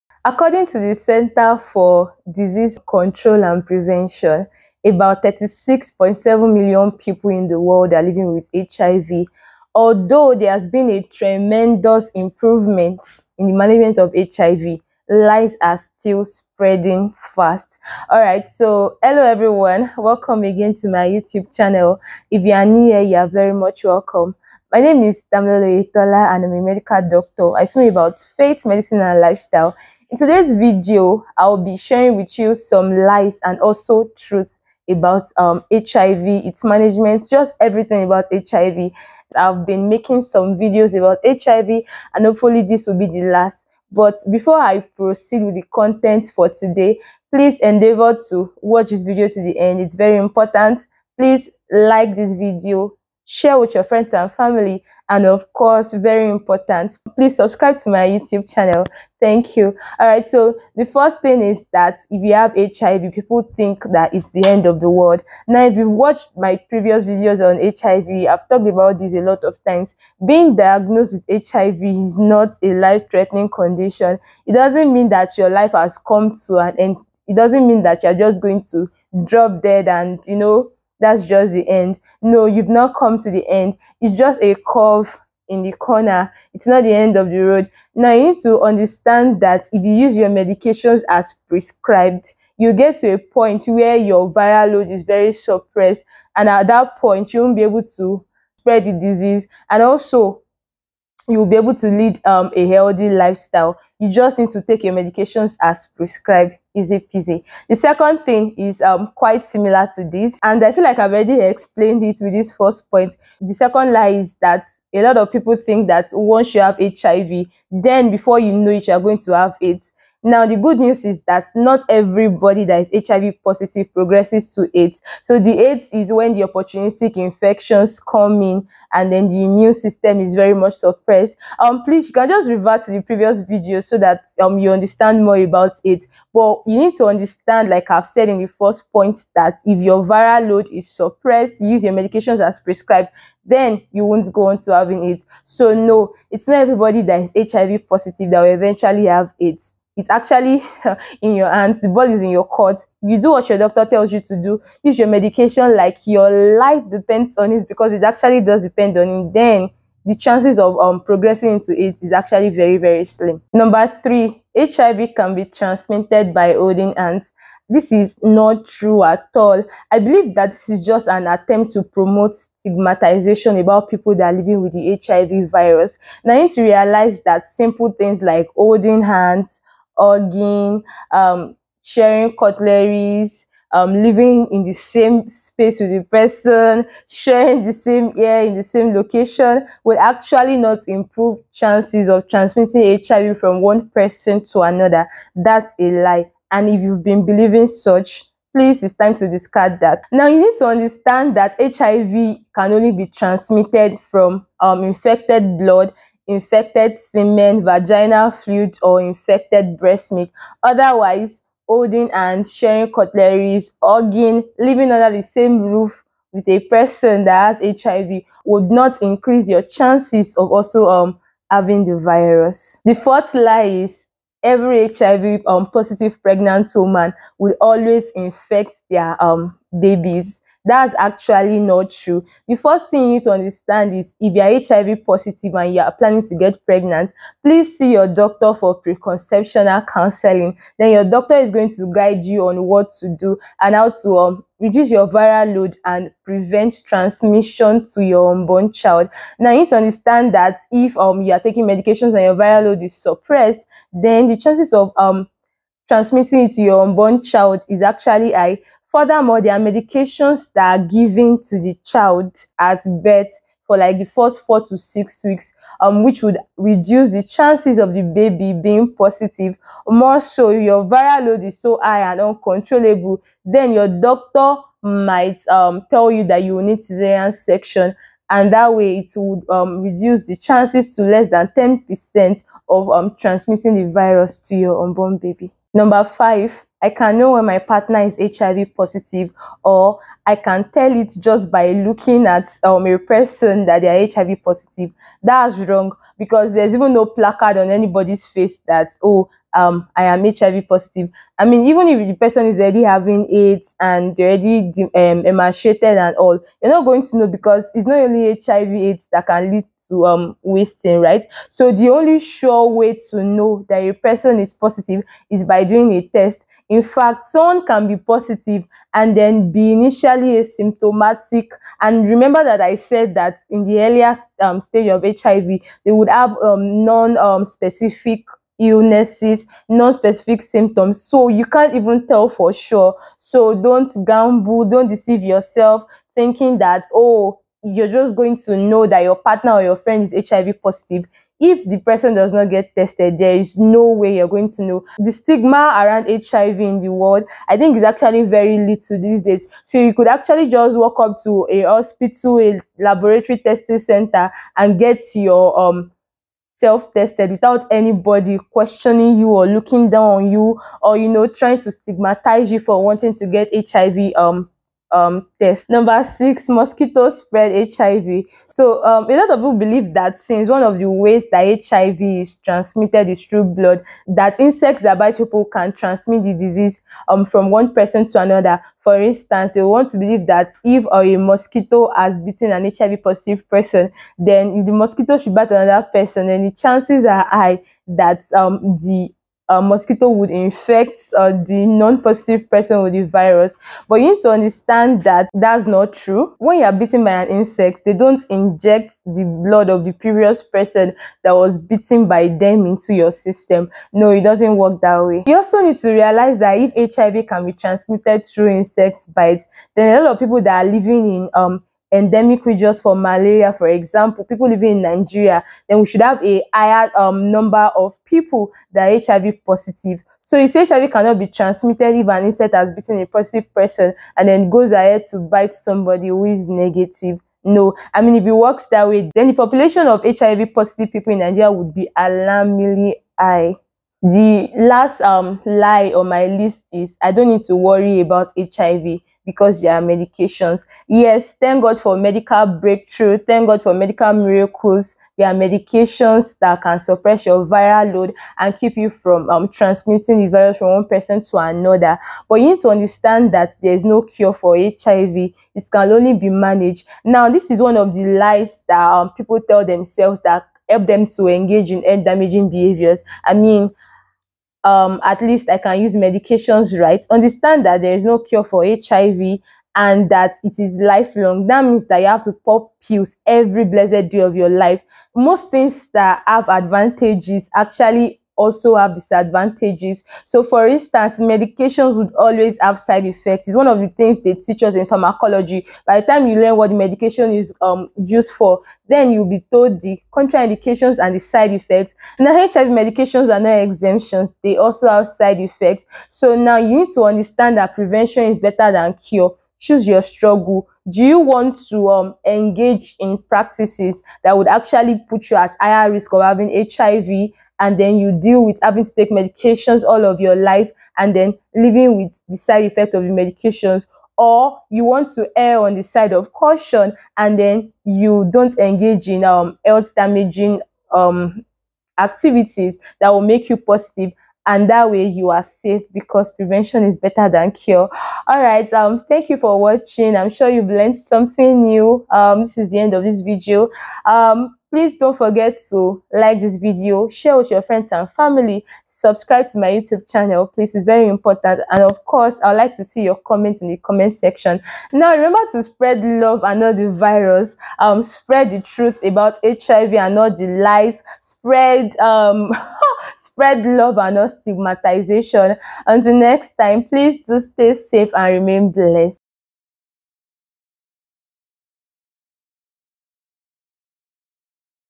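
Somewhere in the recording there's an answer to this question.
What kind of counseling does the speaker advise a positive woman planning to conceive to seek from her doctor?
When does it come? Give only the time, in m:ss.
3:58.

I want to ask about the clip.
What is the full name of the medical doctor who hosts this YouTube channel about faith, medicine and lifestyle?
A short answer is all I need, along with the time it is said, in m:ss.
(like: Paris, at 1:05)
Damilola Oyetola, at 0:25.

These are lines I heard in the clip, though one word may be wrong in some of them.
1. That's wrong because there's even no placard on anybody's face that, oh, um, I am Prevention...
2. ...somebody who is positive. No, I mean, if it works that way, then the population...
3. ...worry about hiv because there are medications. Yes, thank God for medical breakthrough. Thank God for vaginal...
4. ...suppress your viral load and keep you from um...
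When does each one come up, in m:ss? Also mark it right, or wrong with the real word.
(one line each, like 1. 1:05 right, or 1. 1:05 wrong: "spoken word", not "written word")
1. 4:55 wrong: "HIV", not "Prevention"
2. 7:05 wrong: "negative", not "positive"
3. 7:17 wrong: "medical", not "vaginal"
4. 7:26 right.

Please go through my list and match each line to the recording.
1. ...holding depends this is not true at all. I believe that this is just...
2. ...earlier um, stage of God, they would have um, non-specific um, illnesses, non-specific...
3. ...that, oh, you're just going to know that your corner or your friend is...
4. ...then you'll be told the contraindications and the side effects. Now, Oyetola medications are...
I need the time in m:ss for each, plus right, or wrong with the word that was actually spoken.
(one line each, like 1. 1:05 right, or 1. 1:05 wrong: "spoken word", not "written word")
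1. 2:46 wrong: "hands", not "depends"
2. 5:23 wrong: "HIV", not "God"
3. 5:36 wrong: "partner", not "corner"
4. 8:08 wrong: "HIV", not "Oyetola".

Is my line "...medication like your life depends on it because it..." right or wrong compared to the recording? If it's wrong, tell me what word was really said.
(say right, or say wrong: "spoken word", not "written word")
right.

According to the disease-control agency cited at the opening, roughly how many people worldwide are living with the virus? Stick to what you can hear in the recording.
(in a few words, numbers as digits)
36.7 million.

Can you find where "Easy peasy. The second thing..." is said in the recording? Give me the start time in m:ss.
1:46.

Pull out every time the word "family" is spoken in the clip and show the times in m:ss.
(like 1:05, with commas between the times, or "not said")
0:54, 8:58.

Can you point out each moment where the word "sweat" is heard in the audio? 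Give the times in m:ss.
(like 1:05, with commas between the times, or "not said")
not said.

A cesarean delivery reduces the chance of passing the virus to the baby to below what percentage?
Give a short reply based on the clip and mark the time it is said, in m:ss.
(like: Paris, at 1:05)
Less than 10%, at 4:41.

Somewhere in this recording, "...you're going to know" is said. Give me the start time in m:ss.
5:44.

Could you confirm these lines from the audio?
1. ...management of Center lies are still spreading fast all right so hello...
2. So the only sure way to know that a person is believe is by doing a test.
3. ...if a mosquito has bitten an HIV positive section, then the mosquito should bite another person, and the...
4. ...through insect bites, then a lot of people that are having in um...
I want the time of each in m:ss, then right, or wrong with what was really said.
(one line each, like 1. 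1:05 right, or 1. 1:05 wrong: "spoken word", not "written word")
1. 0:13 wrong: "HIV", not "Center"
2. 5:11 wrong: "positive", not "believe"
3. 6:20 wrong: "person", not "section"
4. 6:48 wrong: "living", not "having".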